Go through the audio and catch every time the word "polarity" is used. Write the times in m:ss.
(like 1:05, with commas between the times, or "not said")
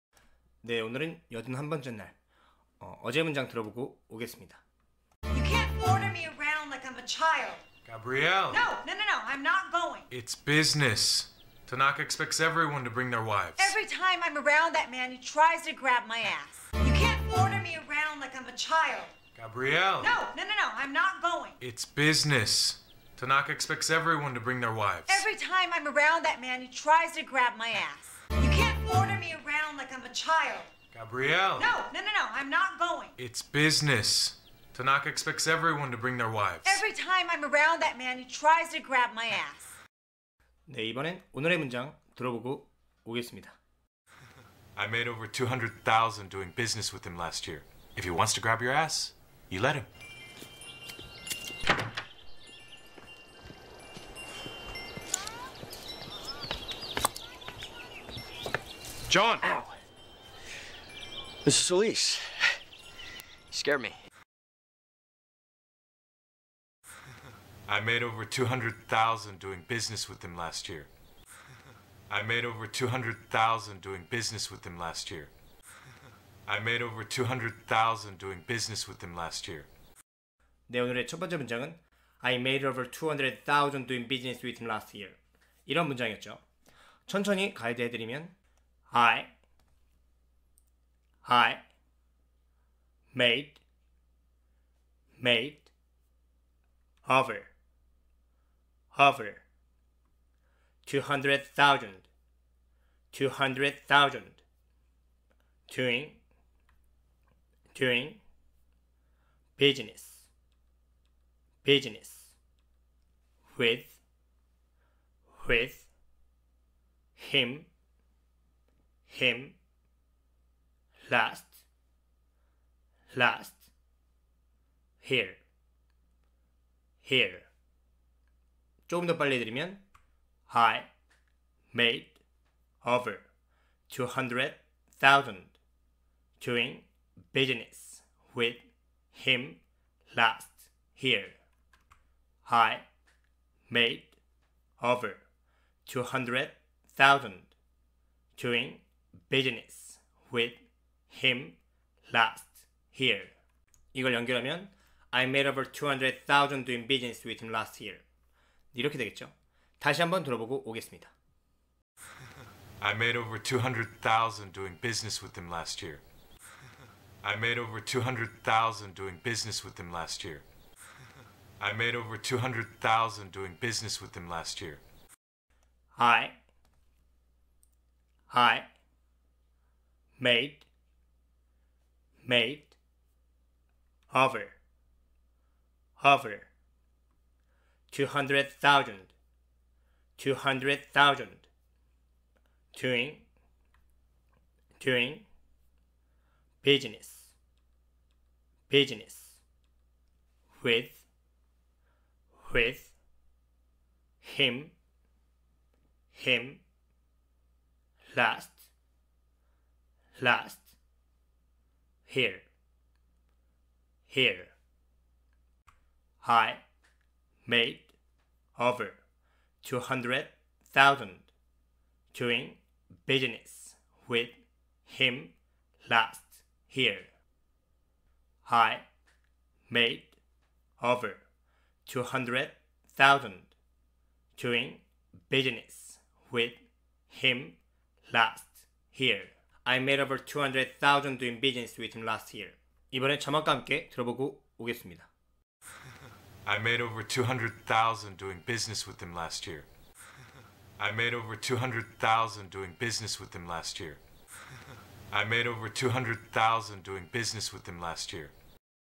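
not said.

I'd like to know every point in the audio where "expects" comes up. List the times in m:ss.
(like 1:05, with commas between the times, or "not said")
0:12, 0:23, 0:35.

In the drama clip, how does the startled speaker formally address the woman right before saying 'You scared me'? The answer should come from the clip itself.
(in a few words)
Mrs. Solis.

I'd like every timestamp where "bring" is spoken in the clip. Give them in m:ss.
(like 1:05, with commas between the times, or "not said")
0:12, 0:24, 0:35.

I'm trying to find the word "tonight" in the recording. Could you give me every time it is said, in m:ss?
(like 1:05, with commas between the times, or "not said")
not said.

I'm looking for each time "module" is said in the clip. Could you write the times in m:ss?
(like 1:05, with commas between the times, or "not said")
not said.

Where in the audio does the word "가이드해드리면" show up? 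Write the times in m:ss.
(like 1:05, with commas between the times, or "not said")
1:27.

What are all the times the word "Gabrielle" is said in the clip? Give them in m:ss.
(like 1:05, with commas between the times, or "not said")
0:07, 0:19, 0:30.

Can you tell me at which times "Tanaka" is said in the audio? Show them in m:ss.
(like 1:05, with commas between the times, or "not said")
0:11, 0:23, 0:34.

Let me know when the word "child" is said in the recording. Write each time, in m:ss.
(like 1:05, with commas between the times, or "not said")
0:07, 0:18, 0:30.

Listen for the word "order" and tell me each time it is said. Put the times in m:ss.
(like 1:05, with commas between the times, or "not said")
0:05, 0:17, 0:28.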